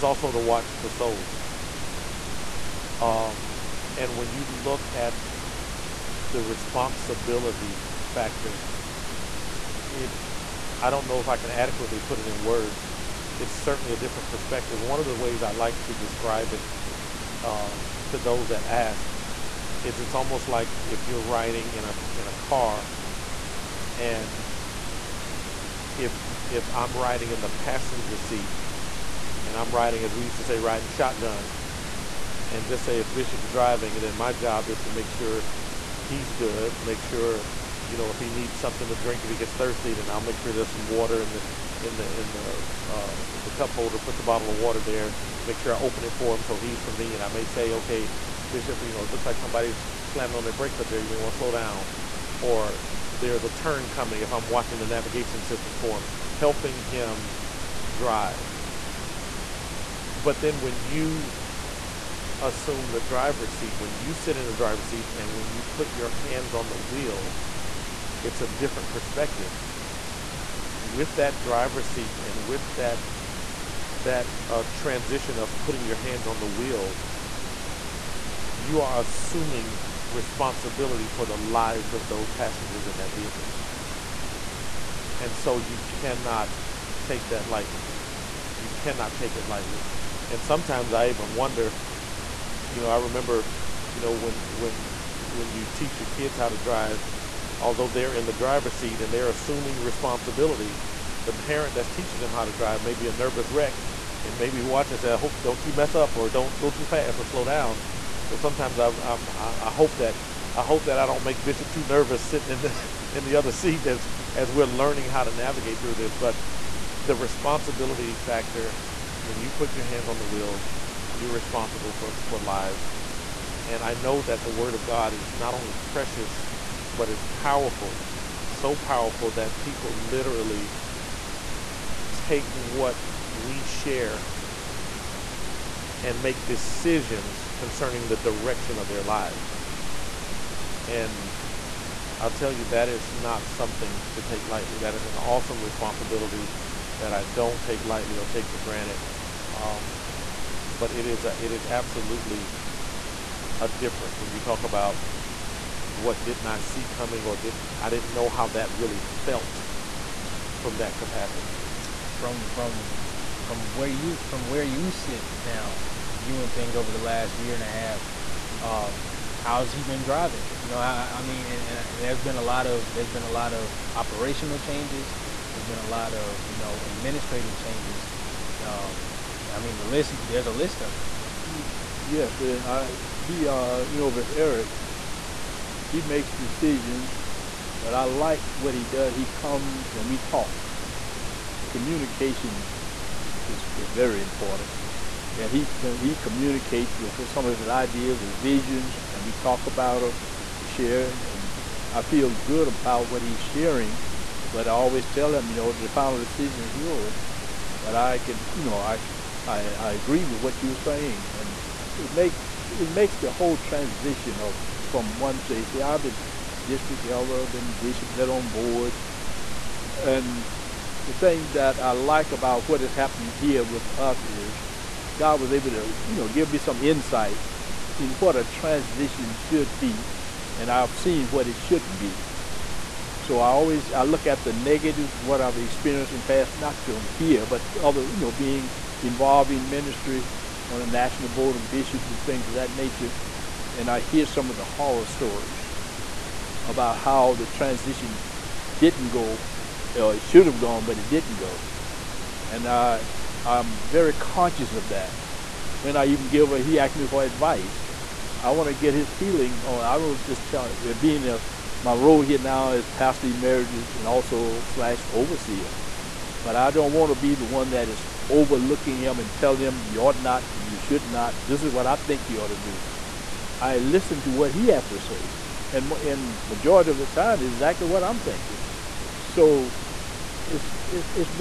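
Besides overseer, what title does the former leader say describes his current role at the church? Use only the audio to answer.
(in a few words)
Pastor emeritus.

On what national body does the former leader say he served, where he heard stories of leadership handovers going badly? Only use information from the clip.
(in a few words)
National Board of Bishops.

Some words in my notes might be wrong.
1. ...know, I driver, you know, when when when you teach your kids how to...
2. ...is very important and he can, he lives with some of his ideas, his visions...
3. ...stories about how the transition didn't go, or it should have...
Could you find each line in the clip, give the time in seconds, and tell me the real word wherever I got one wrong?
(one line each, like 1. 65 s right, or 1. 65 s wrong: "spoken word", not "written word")
1. 92 s wrong: "remember", not "driver"
2. 193 s wrong: "communicates", not "lives"
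3. 245 s right.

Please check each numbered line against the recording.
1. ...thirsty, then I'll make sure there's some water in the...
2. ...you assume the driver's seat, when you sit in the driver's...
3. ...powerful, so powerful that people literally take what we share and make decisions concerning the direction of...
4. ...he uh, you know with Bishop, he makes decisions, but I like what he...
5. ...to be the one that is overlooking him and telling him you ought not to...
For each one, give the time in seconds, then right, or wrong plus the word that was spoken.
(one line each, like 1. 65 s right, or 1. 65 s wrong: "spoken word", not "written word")
1. 39 s right
2. 60 s right
3. 127 s right
4. 183 s wrong: "Eric", not "Bishop"
5. 267 s right.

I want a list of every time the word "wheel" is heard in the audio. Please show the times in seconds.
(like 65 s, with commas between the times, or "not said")
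66 s, 76 s, 120 s.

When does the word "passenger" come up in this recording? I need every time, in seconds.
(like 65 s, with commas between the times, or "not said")
27 s, 82 s.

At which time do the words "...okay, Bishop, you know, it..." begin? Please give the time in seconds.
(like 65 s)
47 s.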